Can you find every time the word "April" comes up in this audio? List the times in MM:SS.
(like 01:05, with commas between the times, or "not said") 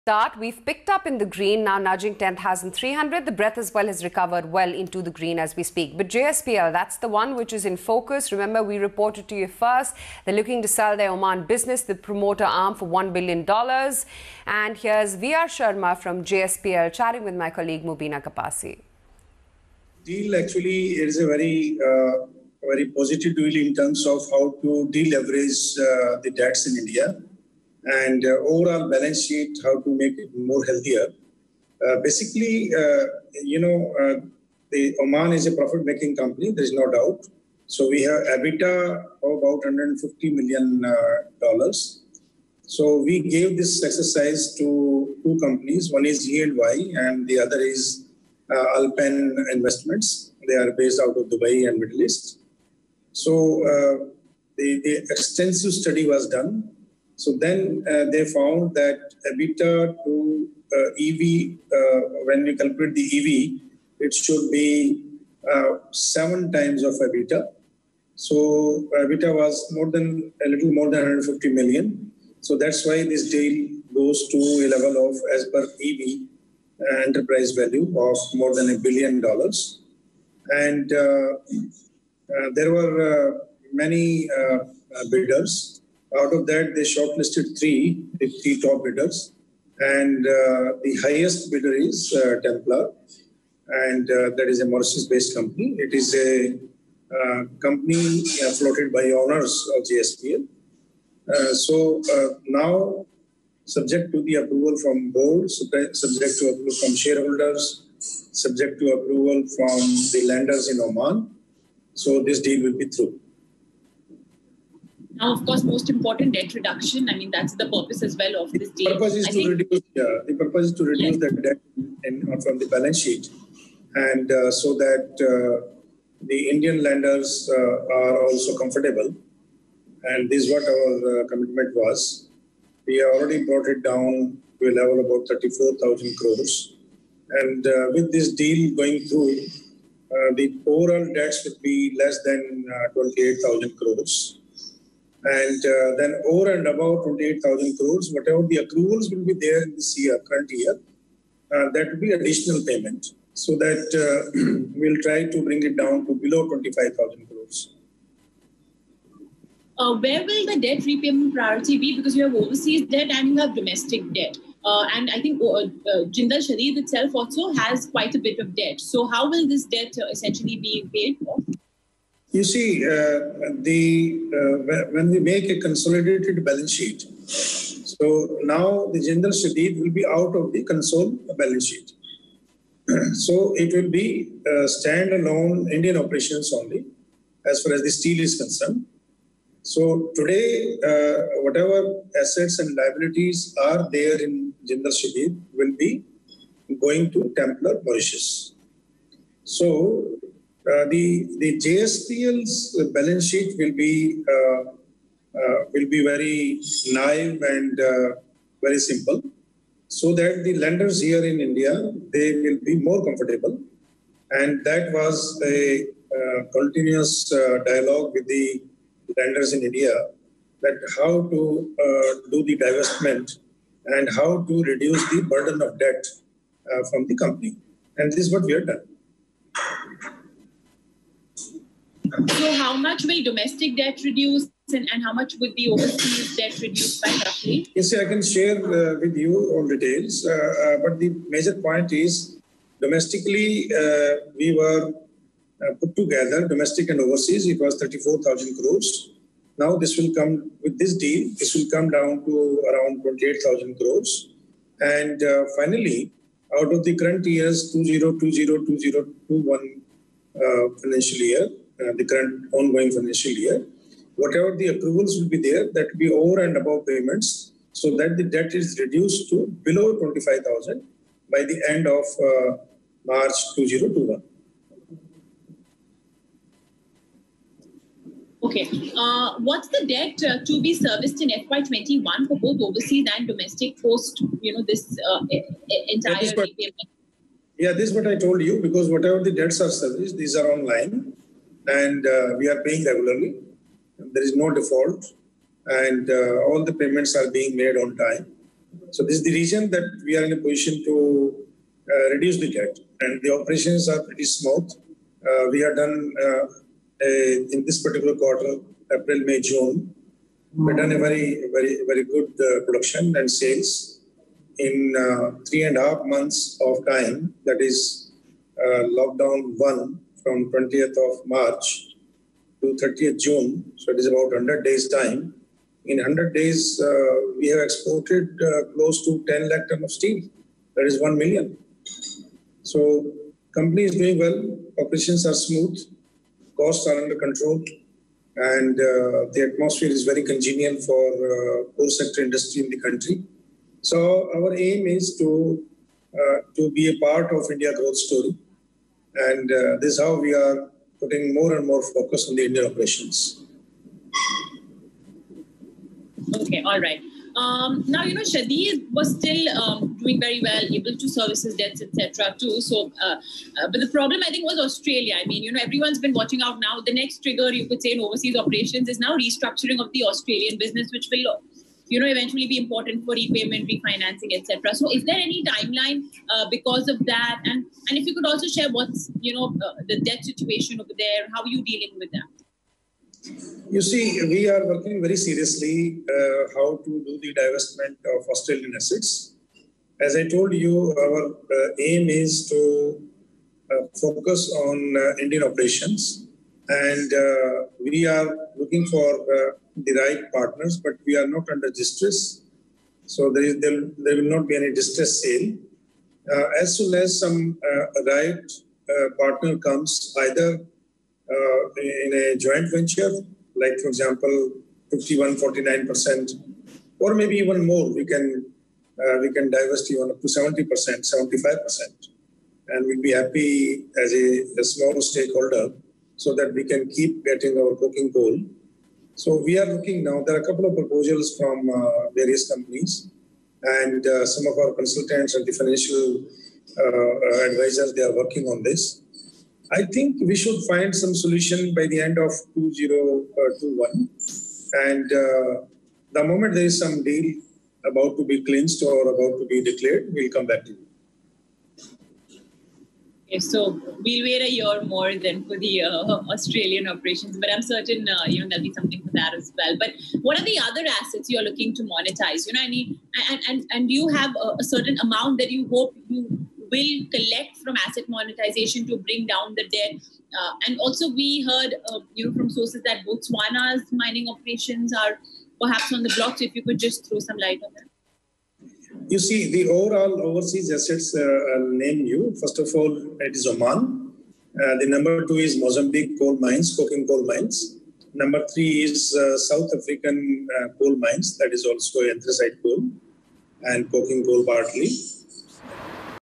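05:08.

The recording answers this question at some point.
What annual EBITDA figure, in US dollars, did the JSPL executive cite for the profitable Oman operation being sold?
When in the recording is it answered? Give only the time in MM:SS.
00:39.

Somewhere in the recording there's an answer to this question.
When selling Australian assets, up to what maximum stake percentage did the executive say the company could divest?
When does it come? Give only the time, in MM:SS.
07:00.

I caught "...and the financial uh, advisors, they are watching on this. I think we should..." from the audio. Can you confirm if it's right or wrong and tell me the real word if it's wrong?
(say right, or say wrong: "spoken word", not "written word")
wrong: "working", not "watching".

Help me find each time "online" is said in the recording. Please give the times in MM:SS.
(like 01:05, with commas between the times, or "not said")
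04:50.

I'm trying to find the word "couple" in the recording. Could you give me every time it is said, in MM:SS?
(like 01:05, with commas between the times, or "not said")
07:10.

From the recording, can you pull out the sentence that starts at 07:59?
You see, the overall overseas assets, uh, I'll name you.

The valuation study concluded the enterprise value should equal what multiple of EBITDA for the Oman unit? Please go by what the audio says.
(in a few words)
7 times.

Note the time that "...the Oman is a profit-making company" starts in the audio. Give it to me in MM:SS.
00:34.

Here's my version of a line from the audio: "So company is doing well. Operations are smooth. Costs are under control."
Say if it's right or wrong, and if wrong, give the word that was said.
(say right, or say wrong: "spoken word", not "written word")
right.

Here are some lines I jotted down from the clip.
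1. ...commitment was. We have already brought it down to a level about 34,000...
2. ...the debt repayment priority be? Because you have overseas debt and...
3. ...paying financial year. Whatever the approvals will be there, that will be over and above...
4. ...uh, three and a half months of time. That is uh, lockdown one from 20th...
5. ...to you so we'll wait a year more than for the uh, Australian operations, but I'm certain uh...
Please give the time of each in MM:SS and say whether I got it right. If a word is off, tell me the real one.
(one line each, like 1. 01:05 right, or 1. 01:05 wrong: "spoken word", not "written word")
1. 02:11 right
2. 02:40 right
3. 04:22 wrong: "ongoing", not "paying"
4. 05:14 right
5. 07:30 right.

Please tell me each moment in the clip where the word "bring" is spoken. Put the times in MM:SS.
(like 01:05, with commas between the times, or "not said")
02:35, 07:48.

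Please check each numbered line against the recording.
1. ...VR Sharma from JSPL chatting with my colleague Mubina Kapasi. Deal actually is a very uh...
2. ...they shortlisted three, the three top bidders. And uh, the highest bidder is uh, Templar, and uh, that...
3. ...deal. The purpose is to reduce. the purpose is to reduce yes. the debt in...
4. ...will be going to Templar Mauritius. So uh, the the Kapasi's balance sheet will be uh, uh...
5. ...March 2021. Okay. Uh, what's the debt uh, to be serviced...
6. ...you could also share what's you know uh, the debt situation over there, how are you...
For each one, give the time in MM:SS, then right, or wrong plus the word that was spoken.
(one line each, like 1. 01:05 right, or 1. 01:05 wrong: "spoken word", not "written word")
1. 00:15 right
2. 01:26 right
3. 01:58 right
4. 03:15 wrong: "JSPL", not "Kapasi"
5. 04:33 right
6. 06:18 right.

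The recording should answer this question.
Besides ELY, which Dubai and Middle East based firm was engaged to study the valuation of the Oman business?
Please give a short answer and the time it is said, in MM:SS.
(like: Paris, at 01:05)
Alpen Investments, at 00:48.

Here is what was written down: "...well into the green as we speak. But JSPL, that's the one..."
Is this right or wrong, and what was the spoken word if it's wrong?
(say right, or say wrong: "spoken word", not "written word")
right.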